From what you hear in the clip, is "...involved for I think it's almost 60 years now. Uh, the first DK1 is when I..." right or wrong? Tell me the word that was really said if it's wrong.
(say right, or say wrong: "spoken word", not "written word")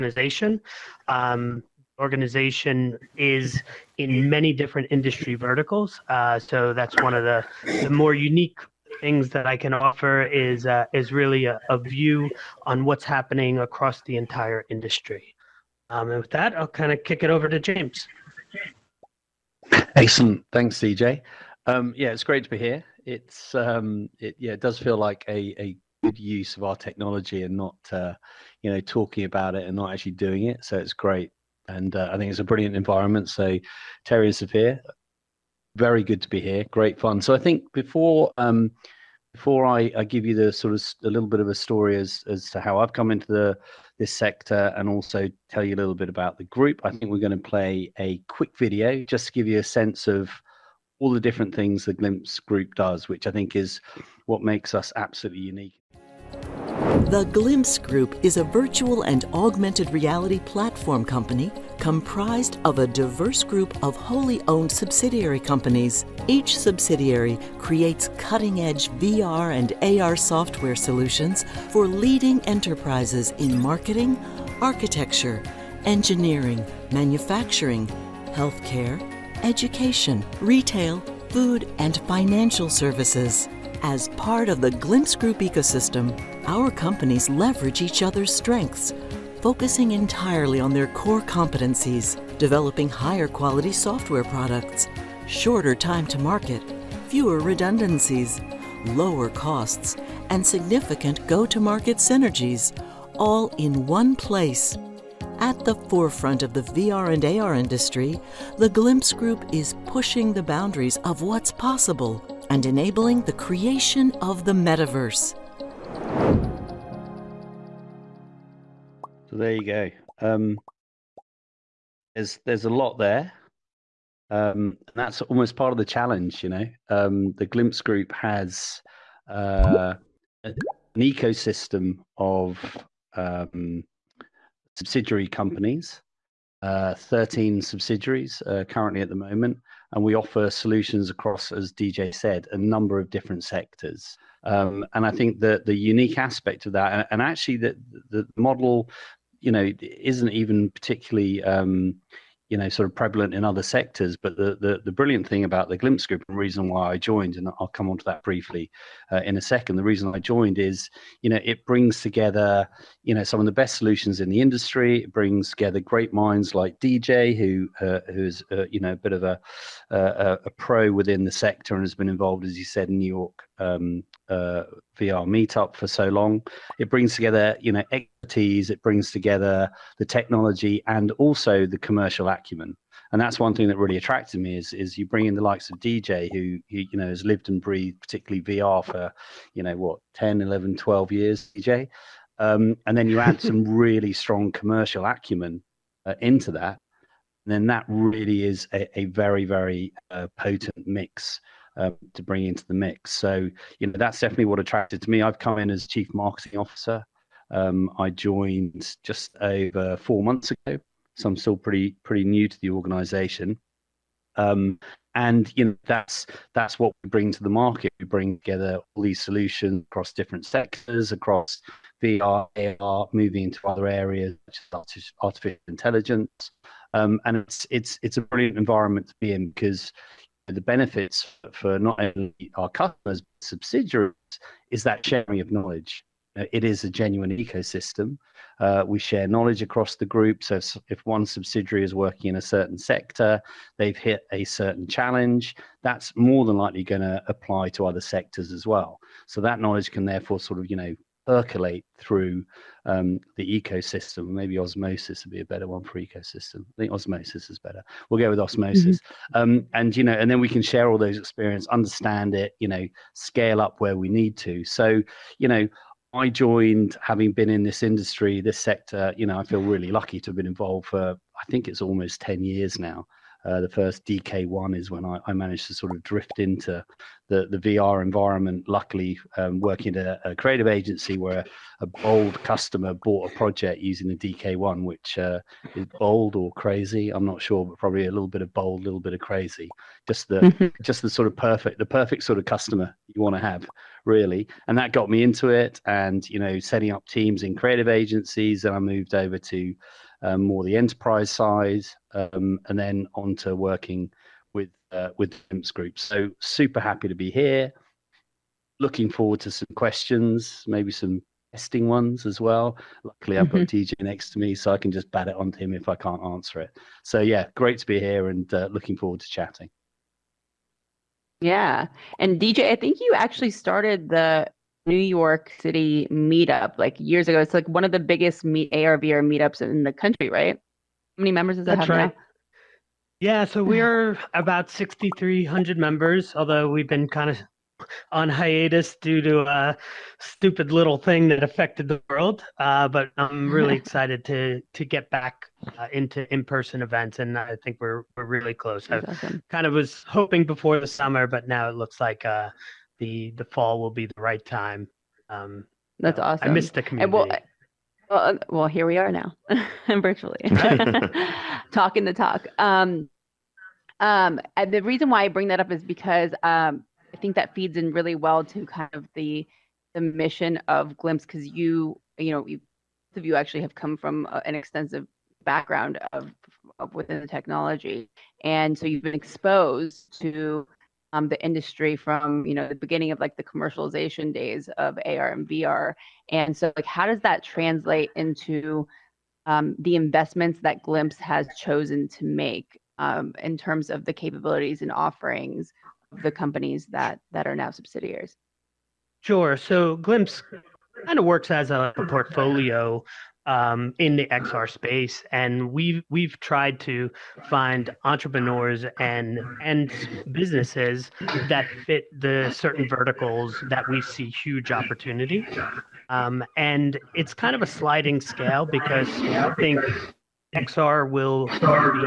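wrong: "10", not "60".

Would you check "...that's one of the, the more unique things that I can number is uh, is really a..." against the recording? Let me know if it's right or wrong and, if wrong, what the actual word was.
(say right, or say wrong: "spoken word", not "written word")
wrong: "offer", not "number".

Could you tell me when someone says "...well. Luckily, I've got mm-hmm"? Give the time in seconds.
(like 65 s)
312 s.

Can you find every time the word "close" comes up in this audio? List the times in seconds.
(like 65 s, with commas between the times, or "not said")
348 s.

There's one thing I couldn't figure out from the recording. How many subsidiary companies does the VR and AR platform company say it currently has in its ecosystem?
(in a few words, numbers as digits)
13.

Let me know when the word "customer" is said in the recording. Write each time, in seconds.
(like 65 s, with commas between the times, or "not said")
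232 s, 282 s, 292 s.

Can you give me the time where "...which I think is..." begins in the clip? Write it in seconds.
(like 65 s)
53 s.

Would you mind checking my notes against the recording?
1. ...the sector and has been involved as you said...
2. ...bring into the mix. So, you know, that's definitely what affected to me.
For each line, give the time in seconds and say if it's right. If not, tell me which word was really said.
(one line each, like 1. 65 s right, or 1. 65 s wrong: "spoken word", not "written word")
1. 171 s right
2. 202 s wrong: "attracted", not "affected".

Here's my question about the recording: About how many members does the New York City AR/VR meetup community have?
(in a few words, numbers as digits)
6,300.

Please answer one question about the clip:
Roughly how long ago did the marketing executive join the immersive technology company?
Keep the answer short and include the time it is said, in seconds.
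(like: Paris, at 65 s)
Just over four months, at 209 s.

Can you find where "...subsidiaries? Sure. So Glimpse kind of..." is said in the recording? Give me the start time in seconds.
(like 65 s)
397 s.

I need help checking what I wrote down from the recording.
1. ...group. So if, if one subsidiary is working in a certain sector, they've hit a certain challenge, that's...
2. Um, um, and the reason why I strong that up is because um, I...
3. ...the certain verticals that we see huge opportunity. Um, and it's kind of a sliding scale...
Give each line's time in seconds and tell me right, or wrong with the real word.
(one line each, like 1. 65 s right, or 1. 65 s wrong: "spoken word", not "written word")
1. 240 s right
2. 362 s wrong: "bring", not "strong"
3. 412 s right.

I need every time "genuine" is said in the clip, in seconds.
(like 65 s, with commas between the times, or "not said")
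236 s.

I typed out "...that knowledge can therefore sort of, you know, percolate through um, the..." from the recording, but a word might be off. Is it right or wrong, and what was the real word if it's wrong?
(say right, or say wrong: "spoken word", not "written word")
right.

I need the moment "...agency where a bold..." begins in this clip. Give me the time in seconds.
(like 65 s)
280 s.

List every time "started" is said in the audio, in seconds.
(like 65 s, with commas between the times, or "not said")
323 s.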